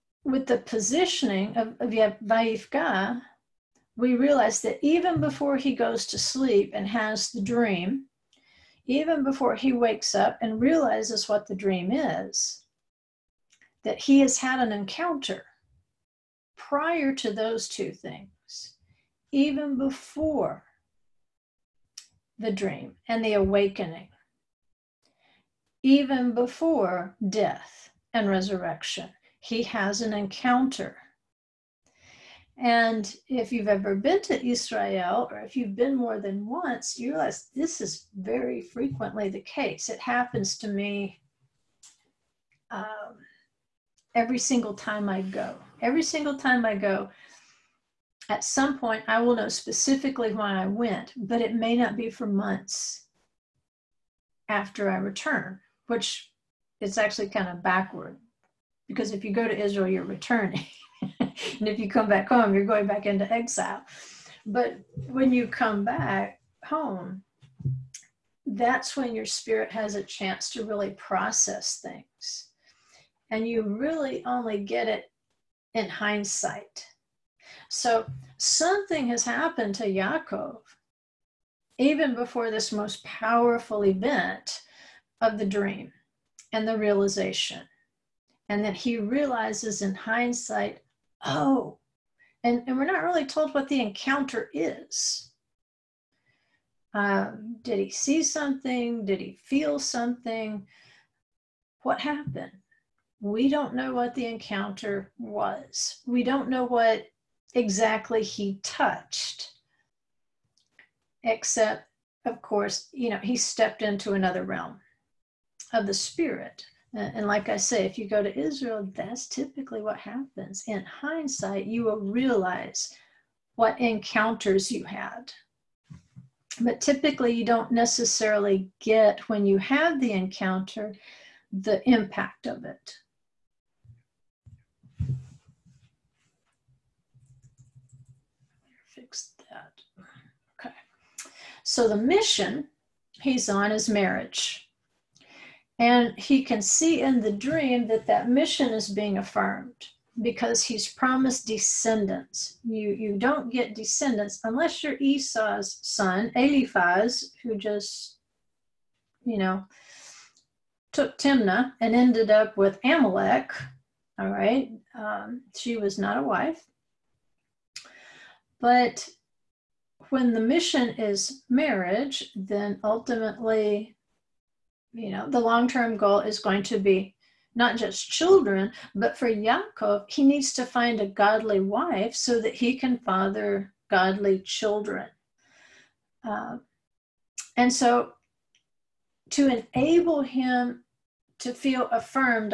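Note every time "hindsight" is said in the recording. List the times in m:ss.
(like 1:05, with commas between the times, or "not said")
1:15, 1:29, 2:00.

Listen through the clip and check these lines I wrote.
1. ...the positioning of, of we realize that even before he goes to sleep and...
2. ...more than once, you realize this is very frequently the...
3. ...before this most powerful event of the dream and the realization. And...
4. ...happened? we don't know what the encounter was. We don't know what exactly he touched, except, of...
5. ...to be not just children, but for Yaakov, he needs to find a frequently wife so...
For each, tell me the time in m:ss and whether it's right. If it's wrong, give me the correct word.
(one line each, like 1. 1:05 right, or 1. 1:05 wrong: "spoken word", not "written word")
1. 0:00 right
2. 0:35 right
3. 1:22 right
4. 1:41 right
5. 2:56 wrong: "godly", not "frequently".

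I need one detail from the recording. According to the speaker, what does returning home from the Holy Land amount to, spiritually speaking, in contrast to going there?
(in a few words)
Going back into exile.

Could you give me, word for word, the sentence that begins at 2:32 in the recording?
You, you don't get descendants unless you're Esau's son, Eliphaz, who just, you know, took Timnah and ended up with Amalek.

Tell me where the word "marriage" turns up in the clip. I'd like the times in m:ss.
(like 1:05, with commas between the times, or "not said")
2:23, 2:51.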